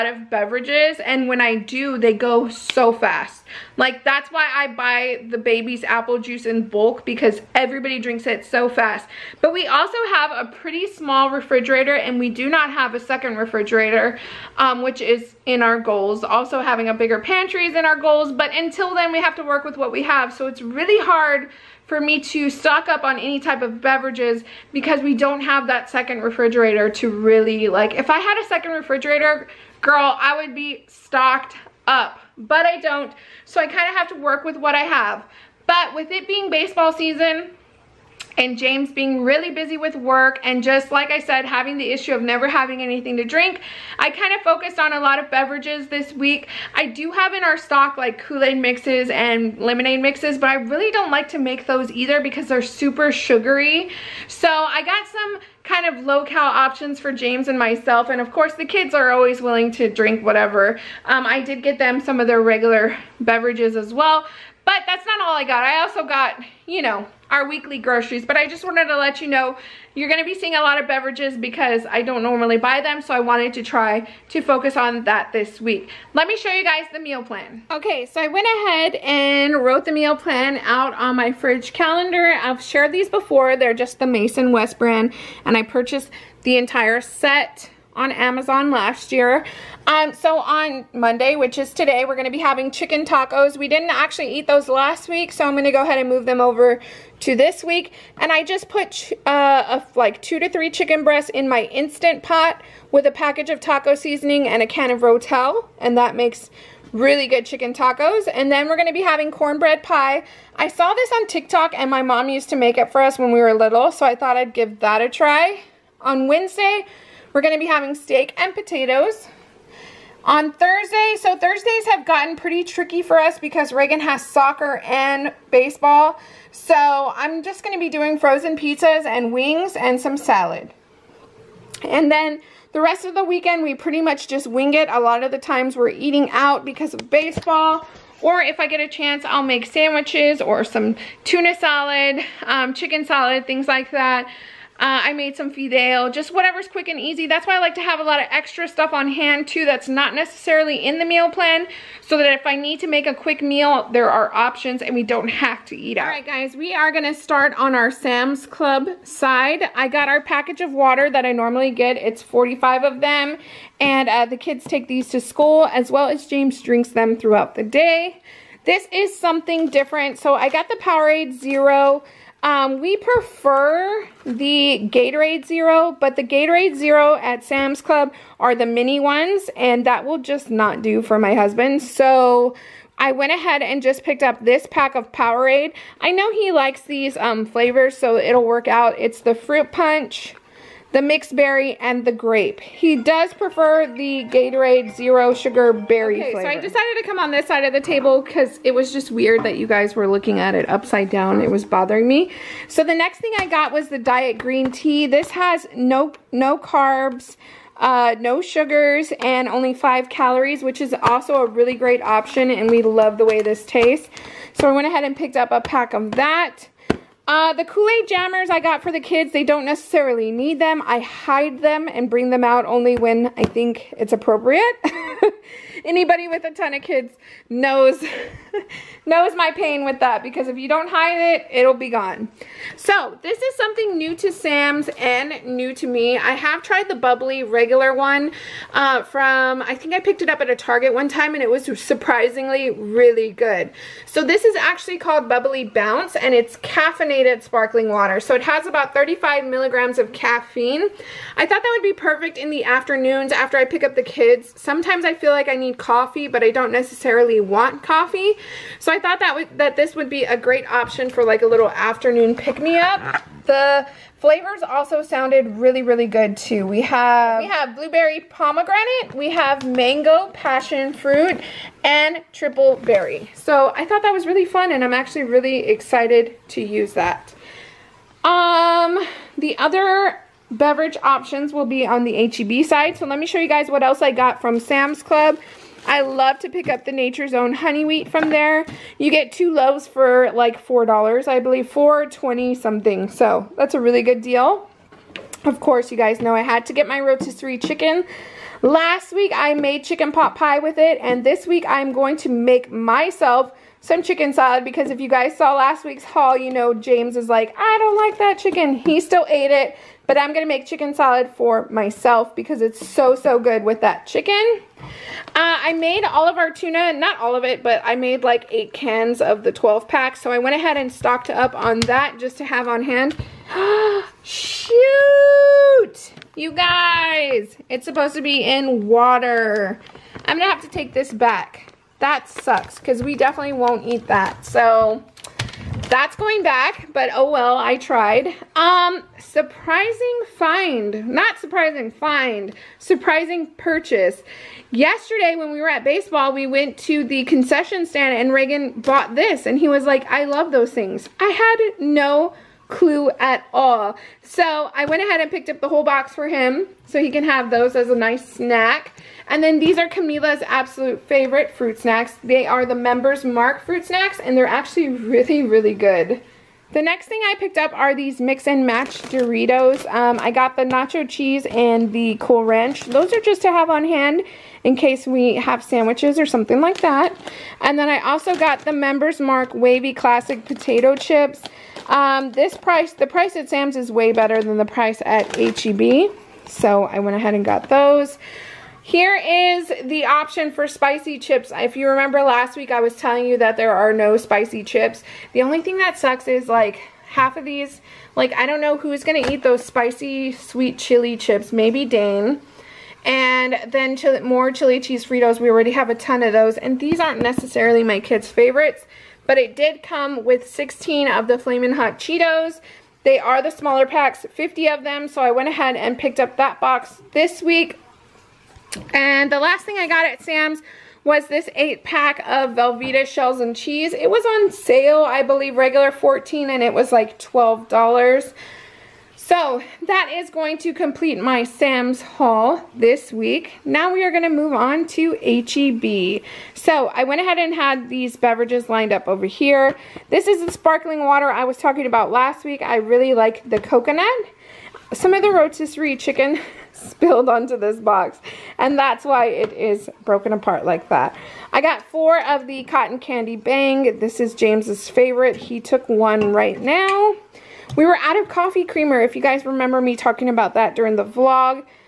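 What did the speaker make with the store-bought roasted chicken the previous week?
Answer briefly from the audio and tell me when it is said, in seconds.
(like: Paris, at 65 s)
chicken pot pie, at 299 s.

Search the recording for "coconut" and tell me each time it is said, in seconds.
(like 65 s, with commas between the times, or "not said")
443 s.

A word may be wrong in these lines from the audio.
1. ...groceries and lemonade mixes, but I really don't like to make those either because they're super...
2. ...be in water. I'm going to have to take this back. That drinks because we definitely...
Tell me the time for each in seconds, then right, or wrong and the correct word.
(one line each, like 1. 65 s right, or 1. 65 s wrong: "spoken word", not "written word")
1. 48 s wrong: "mixes", not "groceries"
2. 328 s wrong: "sucks", not "drinks".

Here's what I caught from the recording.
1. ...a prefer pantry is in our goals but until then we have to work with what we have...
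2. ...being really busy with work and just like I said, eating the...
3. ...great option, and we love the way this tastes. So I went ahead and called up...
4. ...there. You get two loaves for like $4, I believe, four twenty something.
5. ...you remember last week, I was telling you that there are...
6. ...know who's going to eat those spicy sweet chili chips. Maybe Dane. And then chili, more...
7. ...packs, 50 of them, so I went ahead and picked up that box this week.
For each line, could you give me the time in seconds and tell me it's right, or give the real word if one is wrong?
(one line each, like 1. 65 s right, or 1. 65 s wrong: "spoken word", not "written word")
1. 16 s wrong: "bigger", not "prefer"
2. 38 s wrong: "having", not "eating"
3. 211 s wrong: "picked", not "called"
4. 288 s right
5. 391 s right
6. 398 s right
7. 413 s right.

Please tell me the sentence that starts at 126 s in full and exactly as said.
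So I'm just going to be doing frozen pizzas and wings and some salad.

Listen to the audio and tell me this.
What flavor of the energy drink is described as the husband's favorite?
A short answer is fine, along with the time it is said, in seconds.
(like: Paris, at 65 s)
cotton candy, at 452 s.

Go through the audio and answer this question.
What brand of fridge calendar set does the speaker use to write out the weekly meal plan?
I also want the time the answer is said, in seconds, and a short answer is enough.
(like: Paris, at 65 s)
Mason West, at 84 s.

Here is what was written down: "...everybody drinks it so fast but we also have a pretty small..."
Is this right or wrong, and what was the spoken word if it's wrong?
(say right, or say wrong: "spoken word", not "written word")
right.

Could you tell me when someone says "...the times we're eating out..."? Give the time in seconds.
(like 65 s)
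135 s.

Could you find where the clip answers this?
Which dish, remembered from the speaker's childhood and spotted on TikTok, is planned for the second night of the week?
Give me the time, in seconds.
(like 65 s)
109 s.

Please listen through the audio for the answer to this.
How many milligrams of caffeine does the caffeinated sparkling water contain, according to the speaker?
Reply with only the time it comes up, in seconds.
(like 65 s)
248 s.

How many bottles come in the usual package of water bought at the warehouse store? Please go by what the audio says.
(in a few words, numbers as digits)
45.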